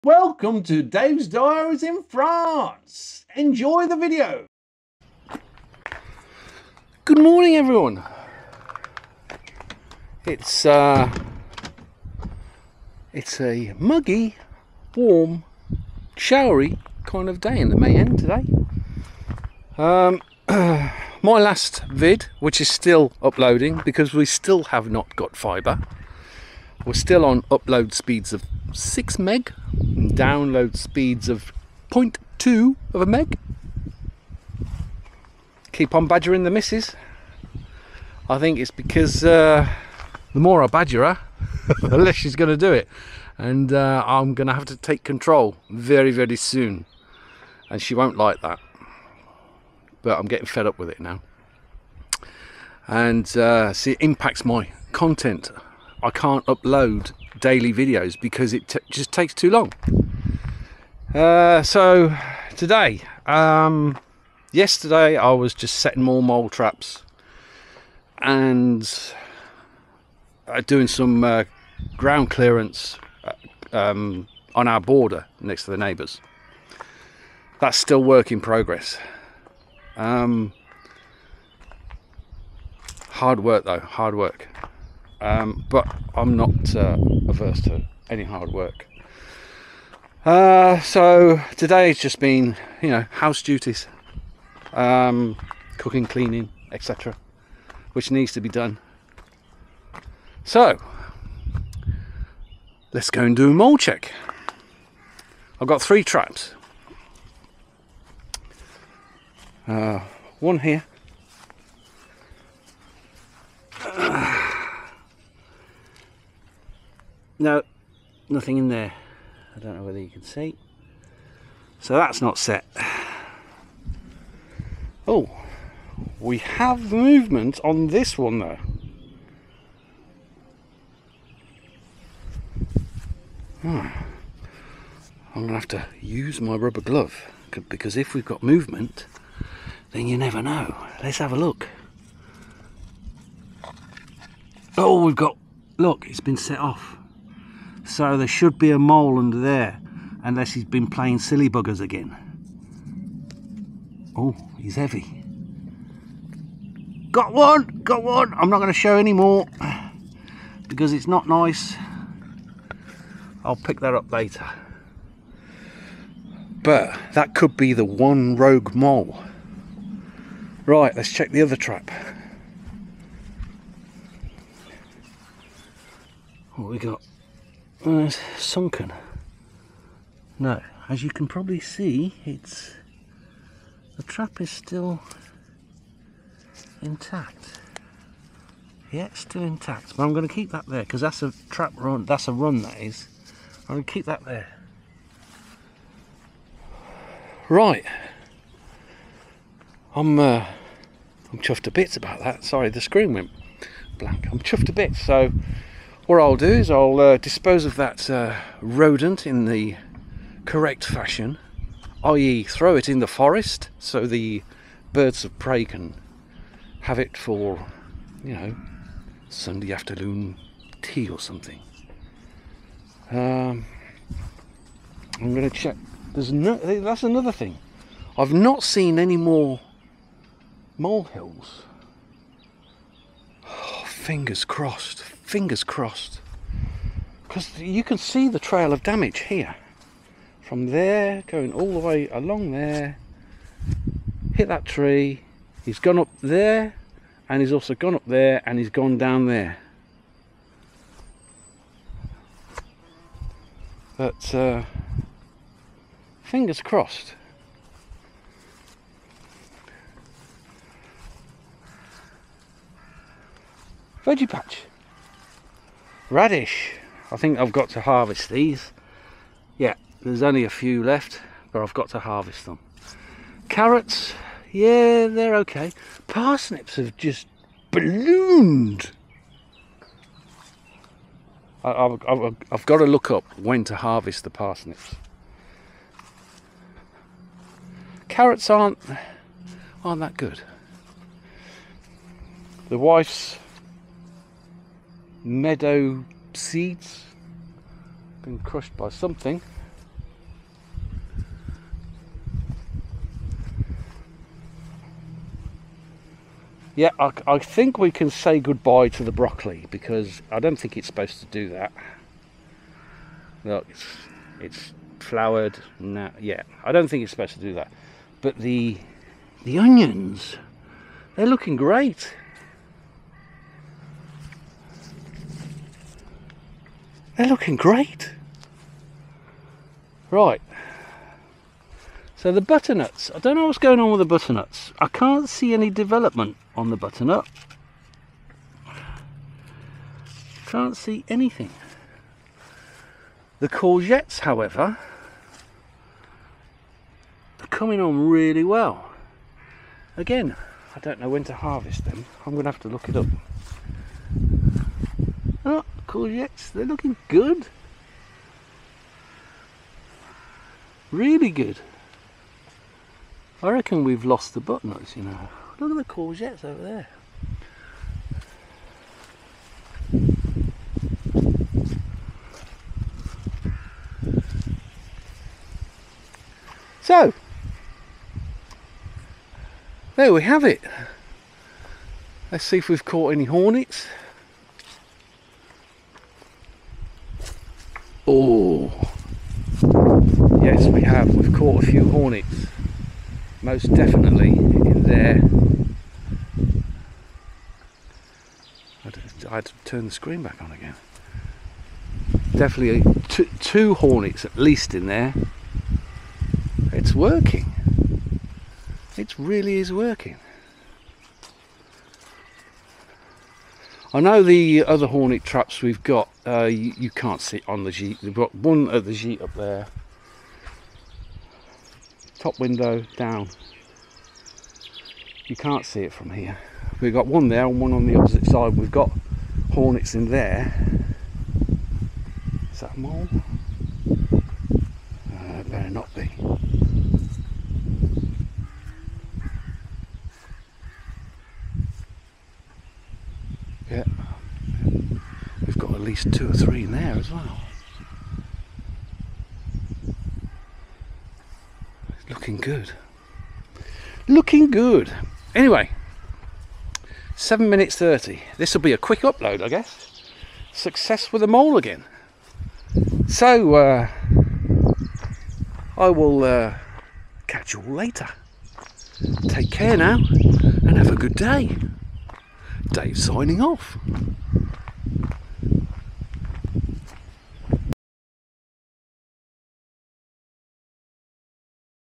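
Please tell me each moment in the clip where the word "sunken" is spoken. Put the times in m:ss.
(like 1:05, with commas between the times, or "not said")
2:58.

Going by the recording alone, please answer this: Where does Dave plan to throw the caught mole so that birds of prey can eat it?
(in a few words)
the forest.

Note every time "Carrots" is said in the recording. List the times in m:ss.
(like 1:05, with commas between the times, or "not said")
4:33, 4:48.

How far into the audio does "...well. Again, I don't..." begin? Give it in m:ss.
5:48.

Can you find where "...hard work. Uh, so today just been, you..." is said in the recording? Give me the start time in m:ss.
1:28.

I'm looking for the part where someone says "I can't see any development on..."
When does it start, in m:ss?
5:34.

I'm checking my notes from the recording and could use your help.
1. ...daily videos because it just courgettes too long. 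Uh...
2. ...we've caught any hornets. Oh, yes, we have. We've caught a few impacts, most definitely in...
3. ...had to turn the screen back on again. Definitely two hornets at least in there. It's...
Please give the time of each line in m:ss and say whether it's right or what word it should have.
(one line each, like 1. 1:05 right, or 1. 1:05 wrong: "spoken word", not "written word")
1. 0:57 wrong: "takes", not "courgettes"
2. 6:22 wrong: "hornets", not "impacts"
3. 6:39 right.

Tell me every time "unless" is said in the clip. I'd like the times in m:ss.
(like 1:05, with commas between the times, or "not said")
2:30.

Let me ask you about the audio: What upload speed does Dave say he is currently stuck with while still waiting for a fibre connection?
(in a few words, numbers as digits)
6 meg.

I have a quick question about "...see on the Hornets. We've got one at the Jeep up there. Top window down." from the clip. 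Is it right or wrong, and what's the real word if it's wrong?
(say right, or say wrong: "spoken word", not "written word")
wrong: "Jeep", not "Hornets".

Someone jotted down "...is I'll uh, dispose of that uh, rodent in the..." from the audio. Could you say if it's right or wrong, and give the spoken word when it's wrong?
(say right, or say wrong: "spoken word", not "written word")
right.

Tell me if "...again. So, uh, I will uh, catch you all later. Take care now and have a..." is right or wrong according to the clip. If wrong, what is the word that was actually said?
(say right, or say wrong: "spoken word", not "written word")
right.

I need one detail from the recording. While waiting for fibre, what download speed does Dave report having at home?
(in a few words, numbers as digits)
0.2 of a meg.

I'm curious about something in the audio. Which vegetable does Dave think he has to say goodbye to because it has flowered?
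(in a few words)
broccoli.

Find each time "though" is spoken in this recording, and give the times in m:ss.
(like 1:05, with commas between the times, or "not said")
1:23, 2:08.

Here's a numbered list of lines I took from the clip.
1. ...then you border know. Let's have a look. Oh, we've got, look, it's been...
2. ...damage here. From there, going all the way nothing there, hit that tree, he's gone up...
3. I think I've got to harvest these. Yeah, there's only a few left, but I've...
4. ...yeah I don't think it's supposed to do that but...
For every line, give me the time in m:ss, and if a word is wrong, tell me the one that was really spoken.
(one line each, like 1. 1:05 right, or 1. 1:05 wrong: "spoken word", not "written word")
1. 2:19 wrong: "never", not "border"
2. 3:58 wrong: "along", not "nothing"
3. 4:27 right
4. 5:16 right.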